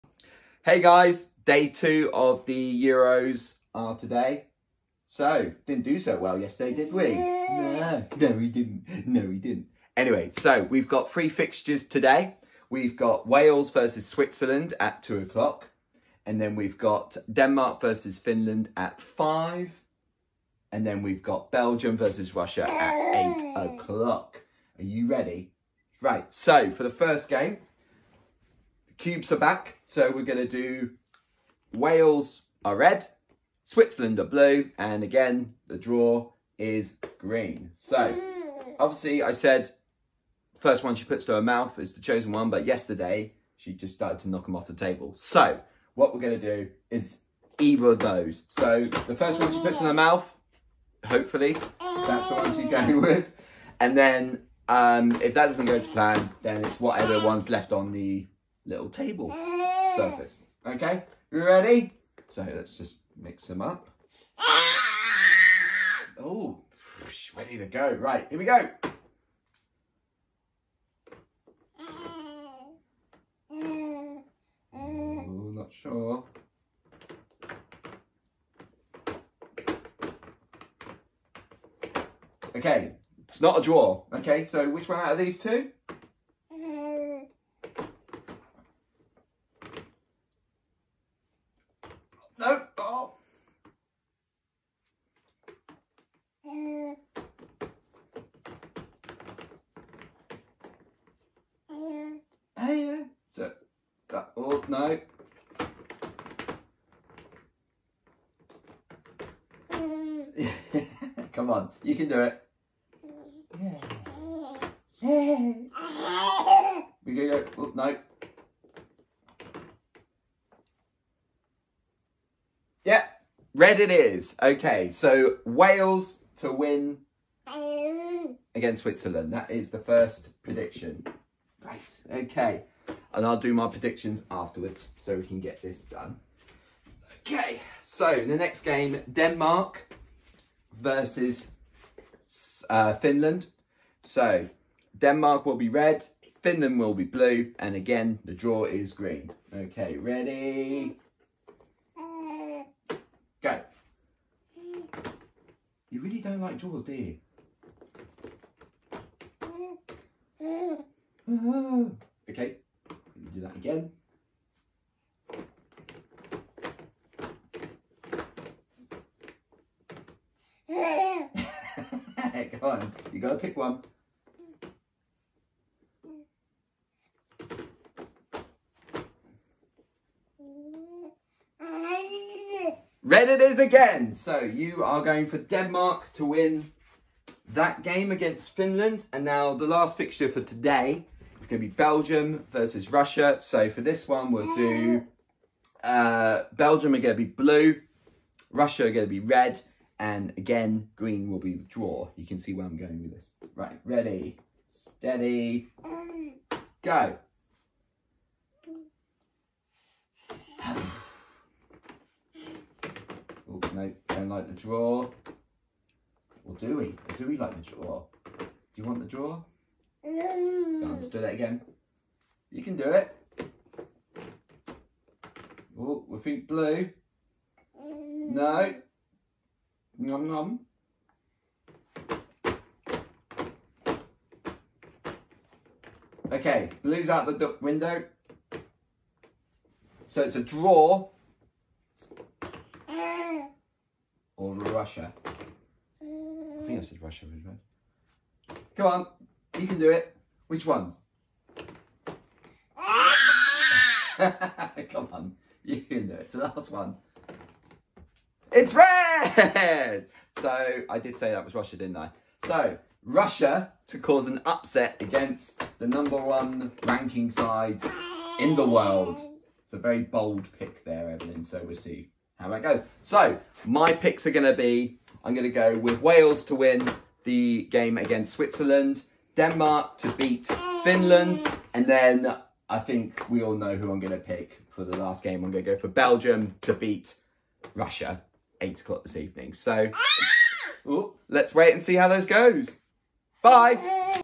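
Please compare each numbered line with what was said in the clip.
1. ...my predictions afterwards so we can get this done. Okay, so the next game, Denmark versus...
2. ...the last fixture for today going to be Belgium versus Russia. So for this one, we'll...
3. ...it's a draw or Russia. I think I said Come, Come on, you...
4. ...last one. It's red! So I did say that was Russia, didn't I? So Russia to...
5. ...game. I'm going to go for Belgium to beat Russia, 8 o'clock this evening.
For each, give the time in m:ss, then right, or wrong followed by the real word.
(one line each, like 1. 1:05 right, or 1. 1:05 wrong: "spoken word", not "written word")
1. 2:13 right
2. 3:09 right
3. 4:00 wrong: "Russia", not "Come"
4. 4:16 right
5. 4:45 right.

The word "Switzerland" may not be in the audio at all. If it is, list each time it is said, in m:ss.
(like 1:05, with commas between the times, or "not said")
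0:14, 0:33, 2:08, 4:38.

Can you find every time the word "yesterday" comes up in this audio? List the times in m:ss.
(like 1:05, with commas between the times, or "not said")
0:06, 0:42.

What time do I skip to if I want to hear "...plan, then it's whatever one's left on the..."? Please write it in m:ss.
0:55.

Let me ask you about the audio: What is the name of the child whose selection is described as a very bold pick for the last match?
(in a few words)
Evelyn.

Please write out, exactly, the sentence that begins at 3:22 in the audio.
You can see where I'm going with this.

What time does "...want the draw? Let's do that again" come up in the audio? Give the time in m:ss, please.
3:38.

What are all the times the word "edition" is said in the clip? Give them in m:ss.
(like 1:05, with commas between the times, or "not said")
not said.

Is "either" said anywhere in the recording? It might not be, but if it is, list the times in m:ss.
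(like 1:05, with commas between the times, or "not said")
0:47.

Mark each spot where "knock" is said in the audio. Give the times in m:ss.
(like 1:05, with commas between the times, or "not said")
0:44.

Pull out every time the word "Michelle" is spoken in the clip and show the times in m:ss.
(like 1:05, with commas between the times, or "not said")
not said.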